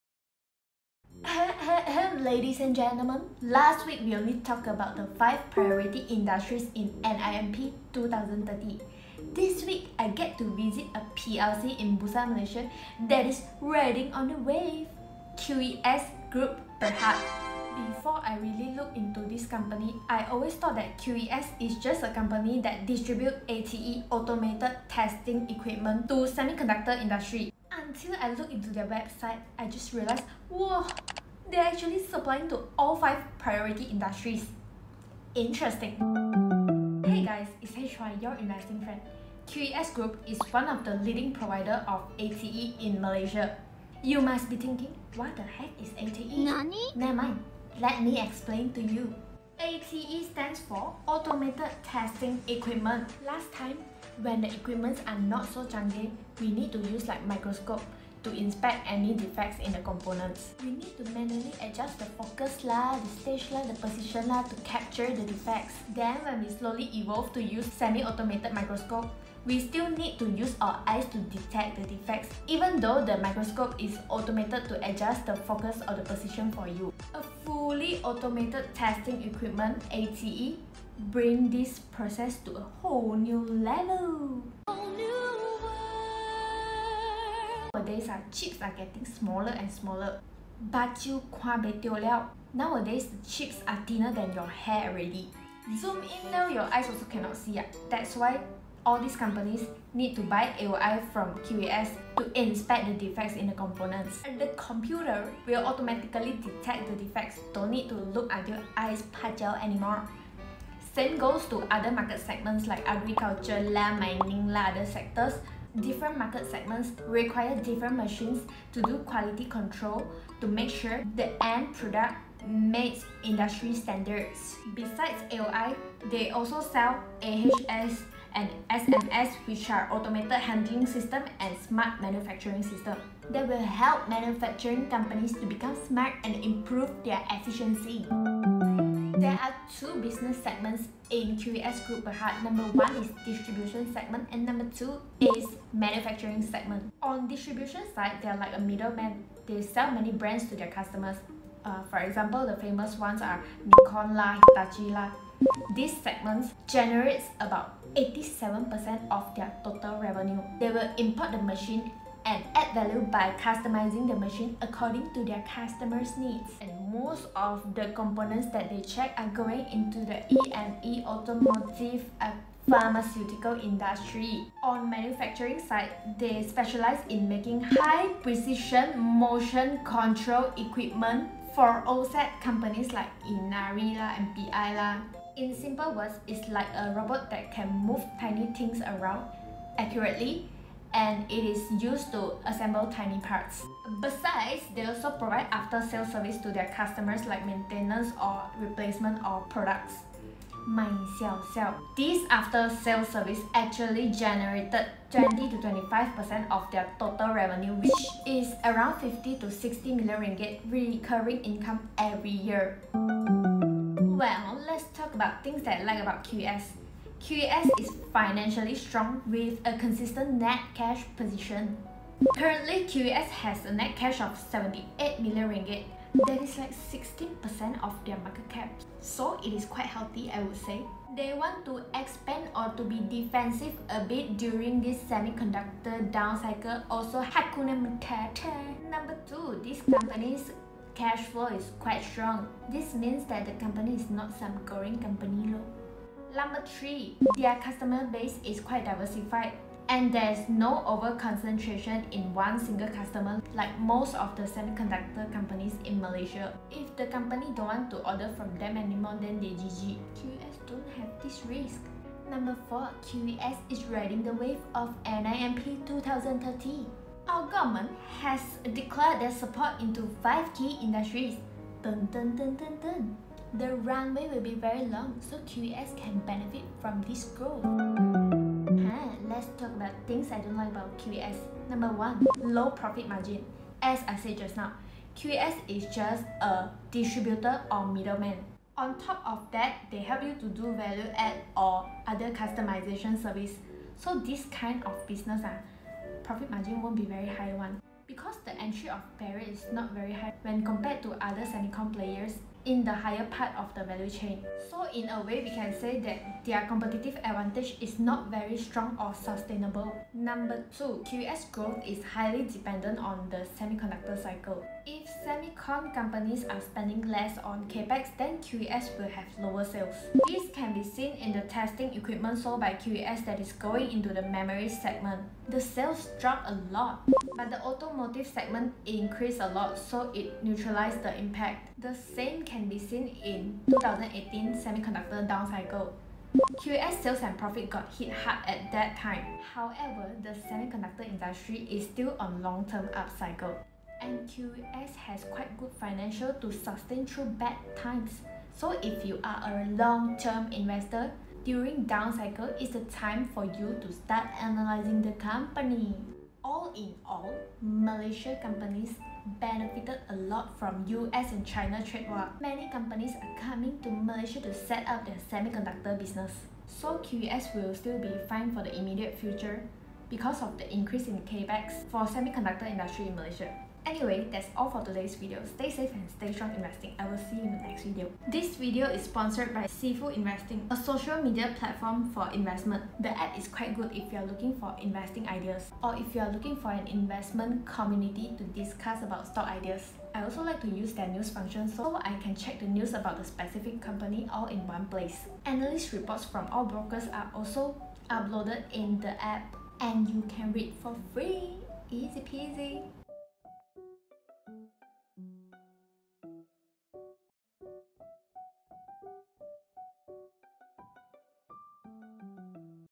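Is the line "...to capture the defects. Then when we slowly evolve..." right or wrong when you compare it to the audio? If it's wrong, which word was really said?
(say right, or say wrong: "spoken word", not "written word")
right.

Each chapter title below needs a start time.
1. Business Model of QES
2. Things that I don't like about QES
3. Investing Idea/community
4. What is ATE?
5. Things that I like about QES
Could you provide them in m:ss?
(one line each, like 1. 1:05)
1. 2:24
2. 4:43
3. 6:25
4. 0:36
5. 3:39.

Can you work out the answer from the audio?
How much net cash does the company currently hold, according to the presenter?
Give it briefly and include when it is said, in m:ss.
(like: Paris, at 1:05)
78 million ringgit, at 3:44.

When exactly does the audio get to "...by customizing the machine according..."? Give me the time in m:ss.
2:43.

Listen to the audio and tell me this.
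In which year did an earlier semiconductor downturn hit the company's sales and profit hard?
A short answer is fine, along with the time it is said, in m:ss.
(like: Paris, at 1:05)
2018, at 5:33.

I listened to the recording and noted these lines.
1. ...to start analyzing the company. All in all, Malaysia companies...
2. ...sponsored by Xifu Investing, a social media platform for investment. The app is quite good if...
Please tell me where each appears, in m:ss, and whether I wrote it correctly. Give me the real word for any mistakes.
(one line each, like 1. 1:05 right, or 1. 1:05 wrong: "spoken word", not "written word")
1. 5:53 right
2. 6:19 right.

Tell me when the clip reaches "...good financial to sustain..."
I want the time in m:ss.
5:45.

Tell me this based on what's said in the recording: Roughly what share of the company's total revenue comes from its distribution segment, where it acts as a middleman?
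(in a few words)
87%.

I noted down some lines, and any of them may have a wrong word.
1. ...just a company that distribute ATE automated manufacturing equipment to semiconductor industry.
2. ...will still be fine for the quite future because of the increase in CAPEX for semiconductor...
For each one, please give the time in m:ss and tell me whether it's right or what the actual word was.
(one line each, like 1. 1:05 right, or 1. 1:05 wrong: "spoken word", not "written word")
1. 0:21 wrong: "testing", not "manufacturing"
2. 6:07 wrong: "immediate", not "quite".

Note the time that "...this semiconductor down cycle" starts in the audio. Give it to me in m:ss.
3:54.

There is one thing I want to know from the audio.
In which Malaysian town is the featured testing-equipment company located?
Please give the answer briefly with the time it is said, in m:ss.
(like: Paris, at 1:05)
Bursa, at 0:11.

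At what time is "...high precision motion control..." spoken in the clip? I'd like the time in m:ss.
2:57.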